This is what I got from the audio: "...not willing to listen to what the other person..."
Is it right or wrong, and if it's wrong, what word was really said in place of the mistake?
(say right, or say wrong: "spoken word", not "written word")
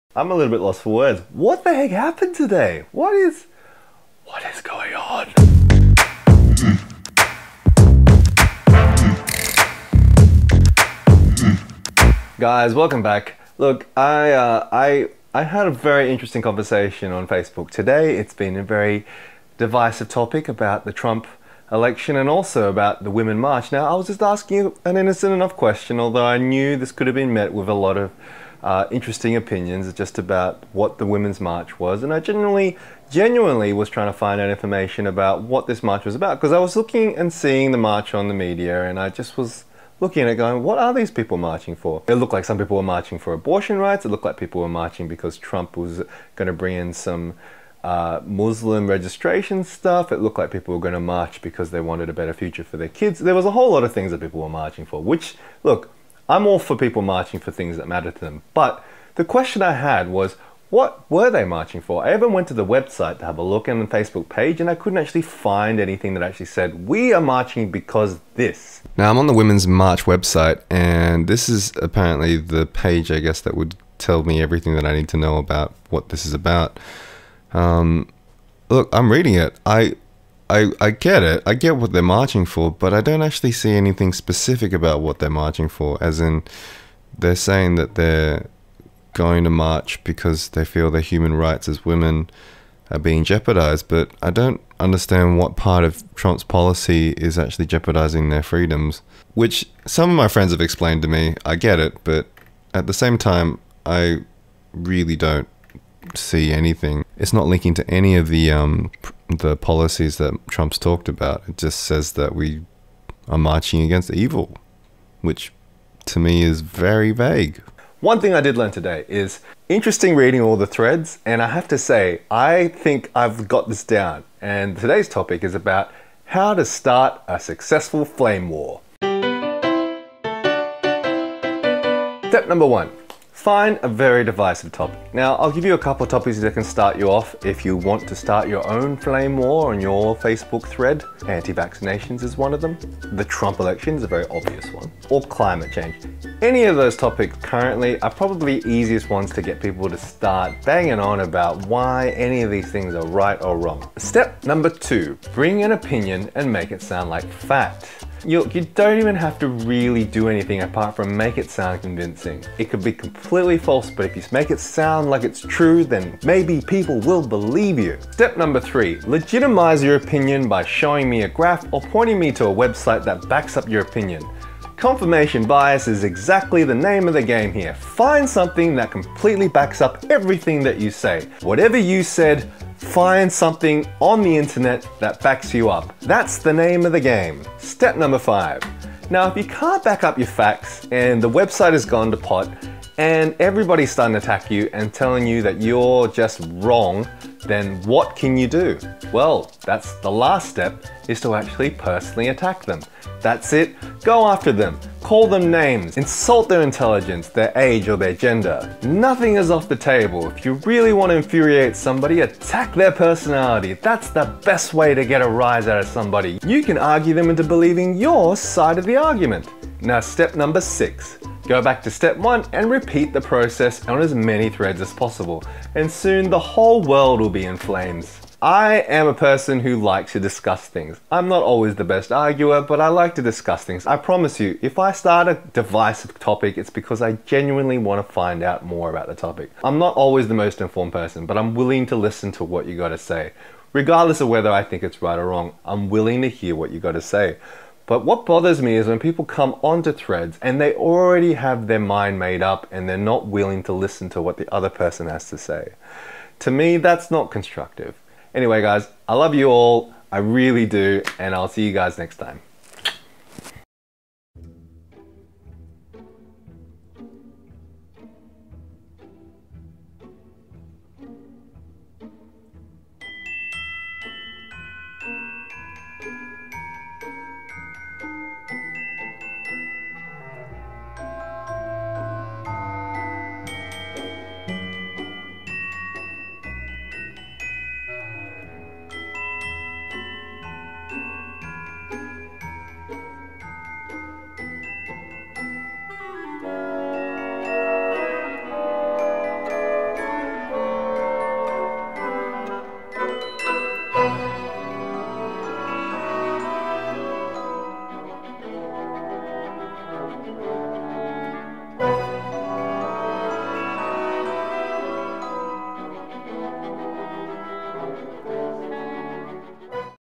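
right.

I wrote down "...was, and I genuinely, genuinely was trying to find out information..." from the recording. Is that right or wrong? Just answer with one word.
right.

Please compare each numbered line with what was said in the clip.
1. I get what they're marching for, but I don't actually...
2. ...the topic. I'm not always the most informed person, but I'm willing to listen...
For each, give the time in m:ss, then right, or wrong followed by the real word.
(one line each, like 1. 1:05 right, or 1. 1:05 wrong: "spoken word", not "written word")
1. 1:21 right
2. 3:59 right.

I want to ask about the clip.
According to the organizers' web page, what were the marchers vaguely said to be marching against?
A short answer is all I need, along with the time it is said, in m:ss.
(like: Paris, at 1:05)
evil, at 1:54.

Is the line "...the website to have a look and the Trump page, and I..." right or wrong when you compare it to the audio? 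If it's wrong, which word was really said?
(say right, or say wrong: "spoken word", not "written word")
wrong: "Facebook", not "Trump".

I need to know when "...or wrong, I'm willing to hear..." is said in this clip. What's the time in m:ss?
4:05.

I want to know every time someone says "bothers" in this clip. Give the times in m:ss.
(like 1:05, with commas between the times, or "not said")
4:08.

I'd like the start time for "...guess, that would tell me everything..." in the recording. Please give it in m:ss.
1:13.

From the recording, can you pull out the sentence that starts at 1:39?
Which some of my friends have explained to me.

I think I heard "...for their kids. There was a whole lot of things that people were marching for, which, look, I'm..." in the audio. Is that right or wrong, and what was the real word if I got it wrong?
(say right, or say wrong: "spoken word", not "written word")
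right.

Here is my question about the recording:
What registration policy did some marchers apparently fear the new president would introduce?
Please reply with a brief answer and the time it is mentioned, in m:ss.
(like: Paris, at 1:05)
Muslim registration, at 0:48.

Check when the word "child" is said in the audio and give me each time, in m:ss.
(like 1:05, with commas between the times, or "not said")
not said.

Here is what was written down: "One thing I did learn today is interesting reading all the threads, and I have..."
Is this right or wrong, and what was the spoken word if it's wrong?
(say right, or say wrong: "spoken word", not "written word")
right.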